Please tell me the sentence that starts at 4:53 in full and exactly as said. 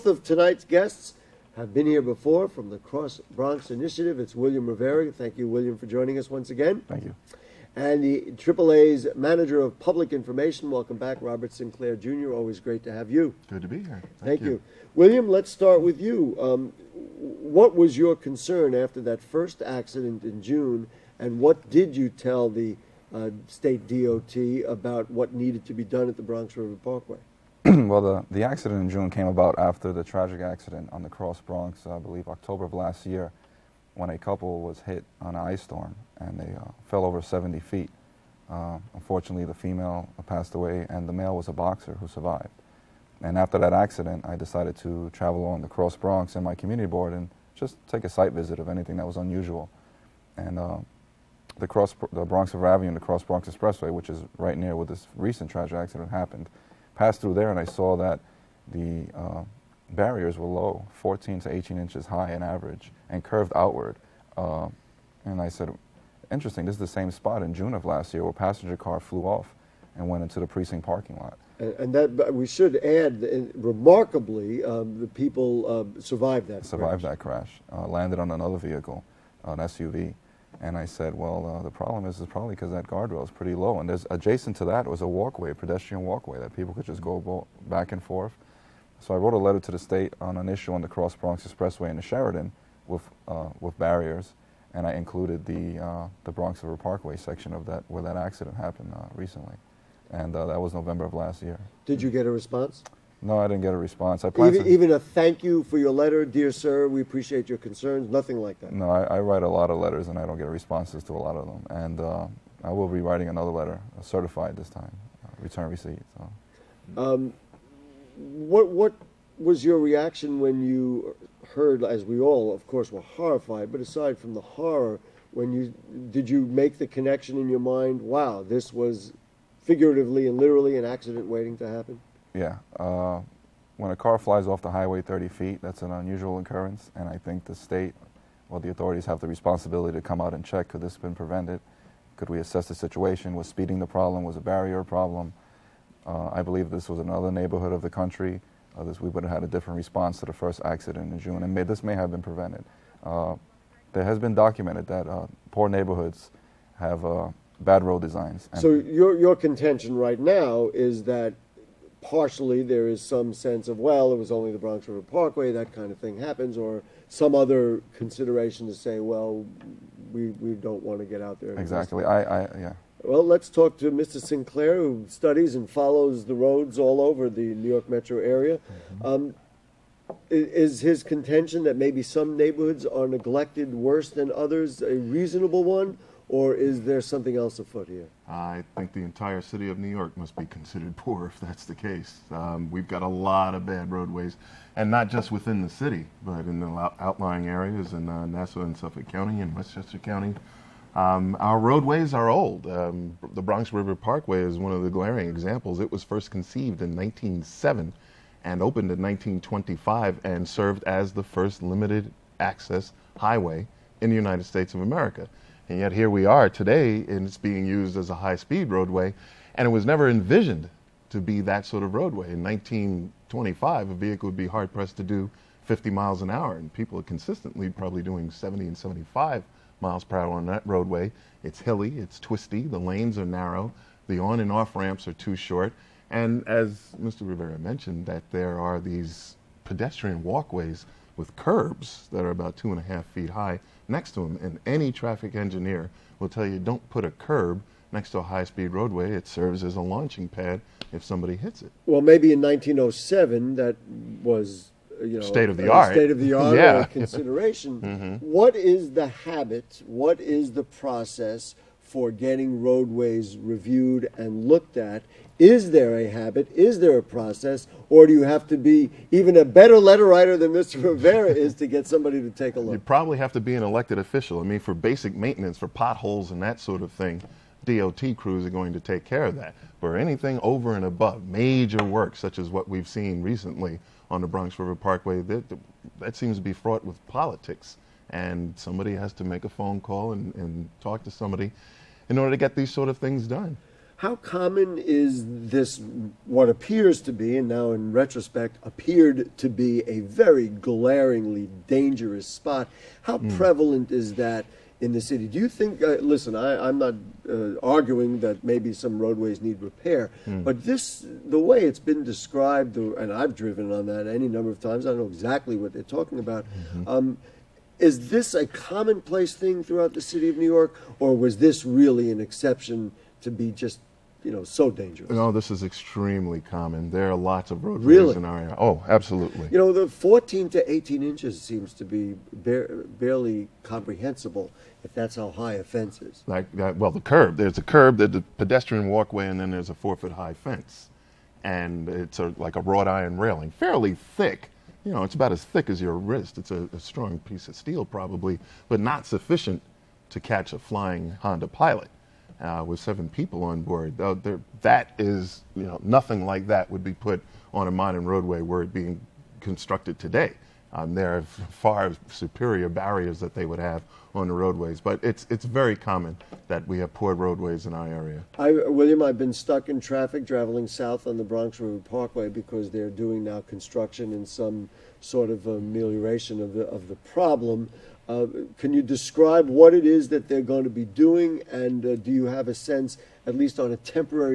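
How common is this, what appears to be, and now in retrospect, appeared to be a very glaringly dangerous spot?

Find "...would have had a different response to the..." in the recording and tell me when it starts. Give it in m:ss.
2:29.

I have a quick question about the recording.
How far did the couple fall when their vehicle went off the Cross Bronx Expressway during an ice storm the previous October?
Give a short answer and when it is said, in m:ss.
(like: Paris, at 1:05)
70 feet, at 0:37.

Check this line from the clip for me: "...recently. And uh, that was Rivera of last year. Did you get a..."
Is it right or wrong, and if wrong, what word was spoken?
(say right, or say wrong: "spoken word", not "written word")
wrong: "November", not "Rivera".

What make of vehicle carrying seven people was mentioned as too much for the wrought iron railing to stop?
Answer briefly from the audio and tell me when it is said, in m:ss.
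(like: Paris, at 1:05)
Honda Pilot, at 5:51.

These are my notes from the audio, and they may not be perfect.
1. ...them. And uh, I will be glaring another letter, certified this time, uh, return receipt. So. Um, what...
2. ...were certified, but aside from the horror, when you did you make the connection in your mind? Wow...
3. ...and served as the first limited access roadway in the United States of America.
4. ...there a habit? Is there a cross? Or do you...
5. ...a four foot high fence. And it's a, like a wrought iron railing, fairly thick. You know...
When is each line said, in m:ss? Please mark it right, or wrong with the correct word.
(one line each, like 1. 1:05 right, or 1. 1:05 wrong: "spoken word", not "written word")
1. 1:51 wrong: "writing", not "glaring"
2. 2:02 wrong: "horrified", not "certified"
3. 3:30 wrong: "highway", not "roadway"
4. 4:25 wrong: "process", not "cross"
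5. 5:39 right.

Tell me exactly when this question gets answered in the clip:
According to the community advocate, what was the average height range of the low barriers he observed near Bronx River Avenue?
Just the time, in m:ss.
1:00.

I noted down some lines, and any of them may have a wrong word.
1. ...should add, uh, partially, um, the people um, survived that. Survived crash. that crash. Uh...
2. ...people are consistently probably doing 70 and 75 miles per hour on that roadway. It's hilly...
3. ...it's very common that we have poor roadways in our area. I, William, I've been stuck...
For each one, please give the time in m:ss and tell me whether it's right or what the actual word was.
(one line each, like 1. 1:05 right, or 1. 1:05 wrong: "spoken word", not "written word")
1. 1:12 wrong: "remarkably", not "partially"
2. 3:46 right
3. 6:05 right.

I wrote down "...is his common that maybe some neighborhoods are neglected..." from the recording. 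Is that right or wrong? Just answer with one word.
wrong.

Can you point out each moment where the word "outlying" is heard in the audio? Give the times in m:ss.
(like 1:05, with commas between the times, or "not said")
3:16.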